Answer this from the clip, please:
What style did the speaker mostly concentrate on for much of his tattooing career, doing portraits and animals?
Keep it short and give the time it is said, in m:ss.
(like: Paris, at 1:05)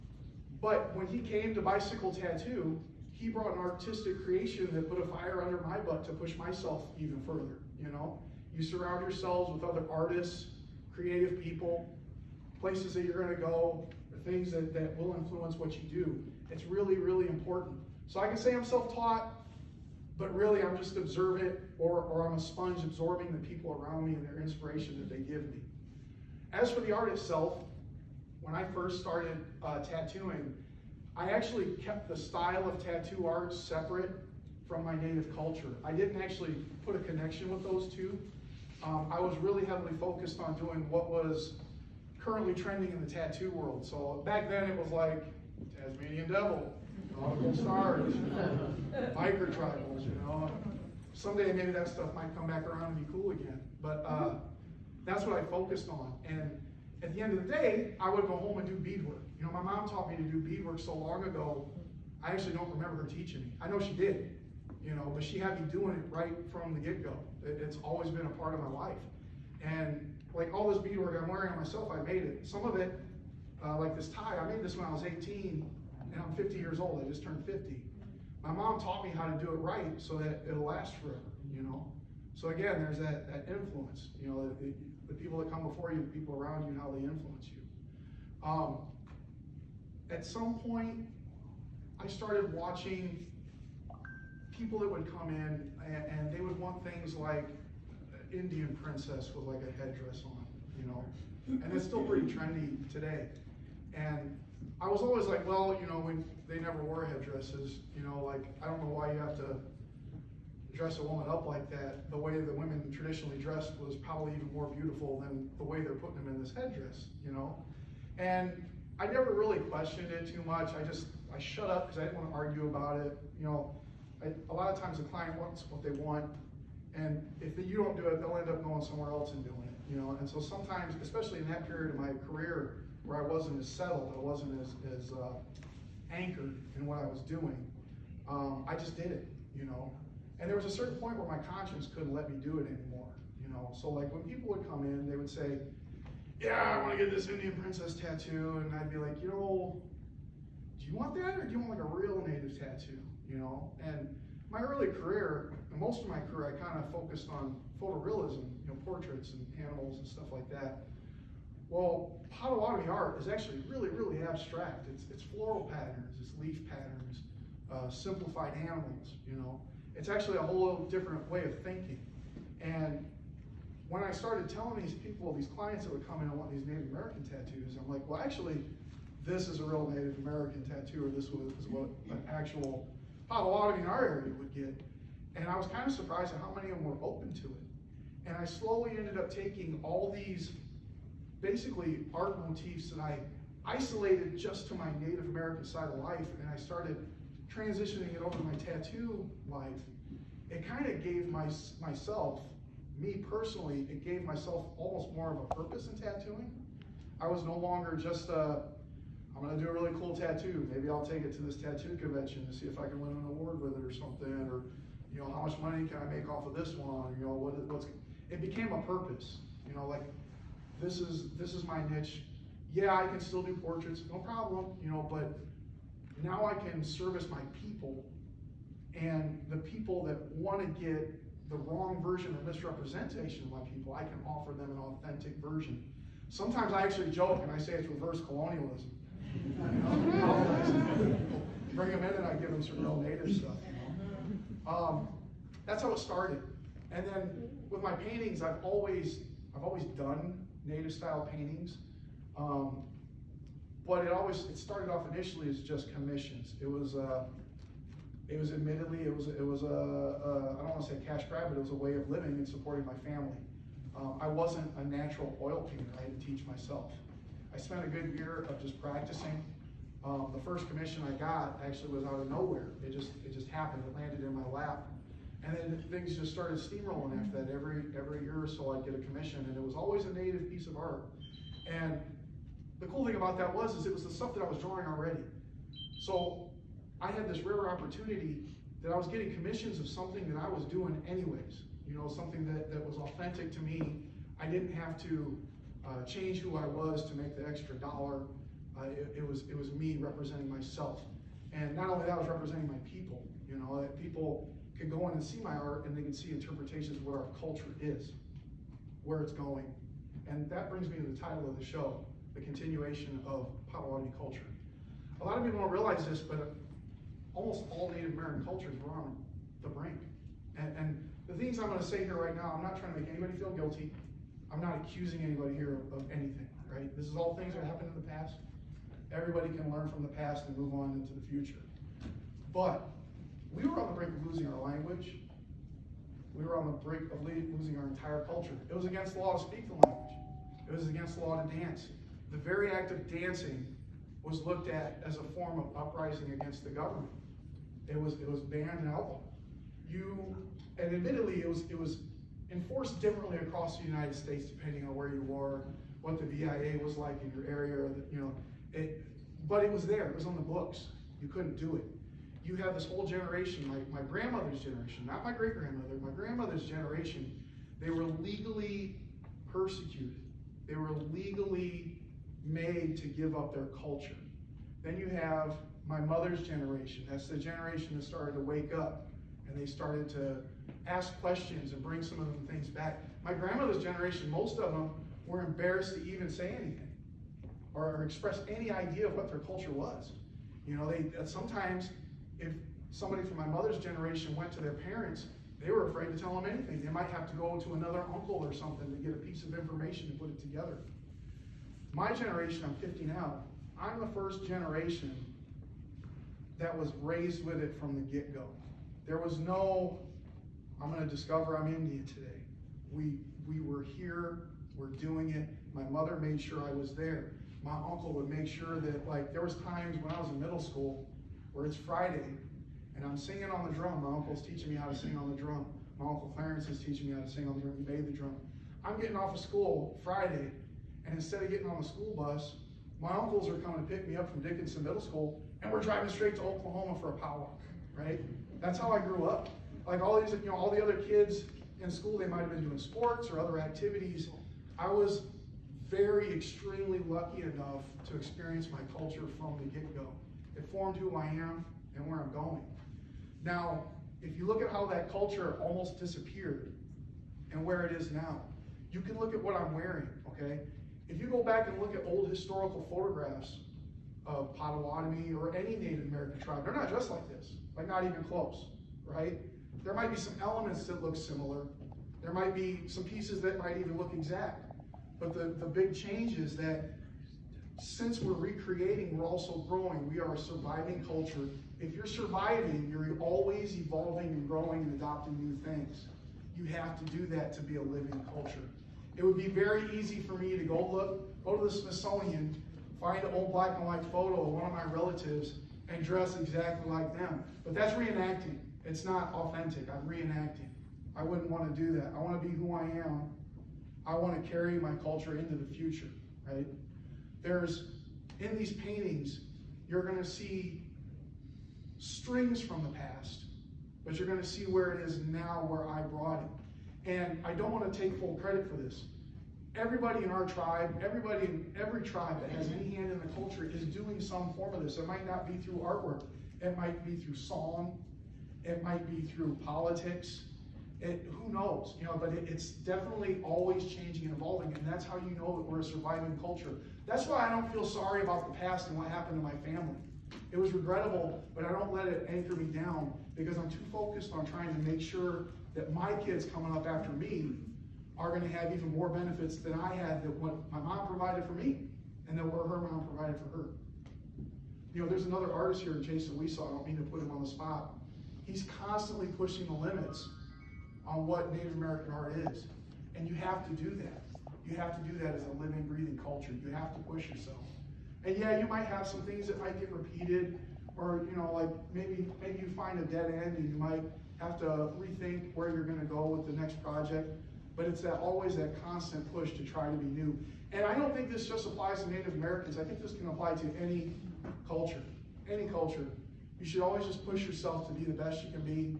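photorealism, at 2:37.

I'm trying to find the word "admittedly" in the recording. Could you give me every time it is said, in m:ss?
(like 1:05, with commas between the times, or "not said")
4:18, 5:50.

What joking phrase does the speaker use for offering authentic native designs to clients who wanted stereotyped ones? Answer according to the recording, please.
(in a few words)
reverse colonialism.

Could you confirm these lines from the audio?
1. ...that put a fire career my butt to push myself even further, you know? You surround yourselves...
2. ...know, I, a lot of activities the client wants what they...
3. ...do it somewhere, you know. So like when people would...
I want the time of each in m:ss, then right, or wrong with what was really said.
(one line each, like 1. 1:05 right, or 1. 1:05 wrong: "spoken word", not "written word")
1. 0:04 wrong: "under", not "career"
2. 2:03 wrong: "times", not "activities"
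3. 2:22 wrong: "anymore", not "somewhere".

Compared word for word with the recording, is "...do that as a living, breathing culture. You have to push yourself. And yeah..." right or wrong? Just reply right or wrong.
right.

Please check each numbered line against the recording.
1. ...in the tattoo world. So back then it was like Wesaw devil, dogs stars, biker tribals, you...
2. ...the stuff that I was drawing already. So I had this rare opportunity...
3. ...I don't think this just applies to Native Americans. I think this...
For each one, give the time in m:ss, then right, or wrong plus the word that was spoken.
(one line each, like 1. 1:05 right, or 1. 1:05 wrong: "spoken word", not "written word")
1. 0:42 wrong: "Tasmanian", not "Wesaw"
2. 4:44 right
3. 9:40 right.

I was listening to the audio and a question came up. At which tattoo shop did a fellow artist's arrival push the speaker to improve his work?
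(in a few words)
Bicycle Tattoo.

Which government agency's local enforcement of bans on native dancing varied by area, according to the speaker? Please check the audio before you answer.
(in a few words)
BIA.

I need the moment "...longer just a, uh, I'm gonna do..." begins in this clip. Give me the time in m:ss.
3:27.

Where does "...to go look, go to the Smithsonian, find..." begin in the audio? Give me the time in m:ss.
8:10.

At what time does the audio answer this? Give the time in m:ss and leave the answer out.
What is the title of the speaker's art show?
5:12.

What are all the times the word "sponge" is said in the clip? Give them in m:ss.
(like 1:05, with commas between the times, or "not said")
0:22.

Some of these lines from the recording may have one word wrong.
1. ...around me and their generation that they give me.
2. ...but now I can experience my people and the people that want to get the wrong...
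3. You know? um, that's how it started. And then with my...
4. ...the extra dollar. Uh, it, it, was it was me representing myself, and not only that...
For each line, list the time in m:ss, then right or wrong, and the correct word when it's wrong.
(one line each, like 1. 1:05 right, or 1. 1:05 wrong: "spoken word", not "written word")
1. 0:23 wrong: "inspiration", not "generation"
2. 3:45 wrong: "service", not "experience"
3. 4:03 right
4. 4:57 right.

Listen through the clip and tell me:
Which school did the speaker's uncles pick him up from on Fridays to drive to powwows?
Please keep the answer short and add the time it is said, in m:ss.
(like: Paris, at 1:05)
Dickinson Middle School, at 7:14.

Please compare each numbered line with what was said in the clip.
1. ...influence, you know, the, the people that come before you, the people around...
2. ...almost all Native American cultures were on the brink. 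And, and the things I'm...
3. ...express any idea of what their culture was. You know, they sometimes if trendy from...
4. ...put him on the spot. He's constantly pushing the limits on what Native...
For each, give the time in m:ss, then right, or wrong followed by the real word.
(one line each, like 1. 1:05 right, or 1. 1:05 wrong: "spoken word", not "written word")
1. 1:23 right
2. 5:17 right
3. 6:28 wrong: "somebody", not "trendy"
4. 9:17 right.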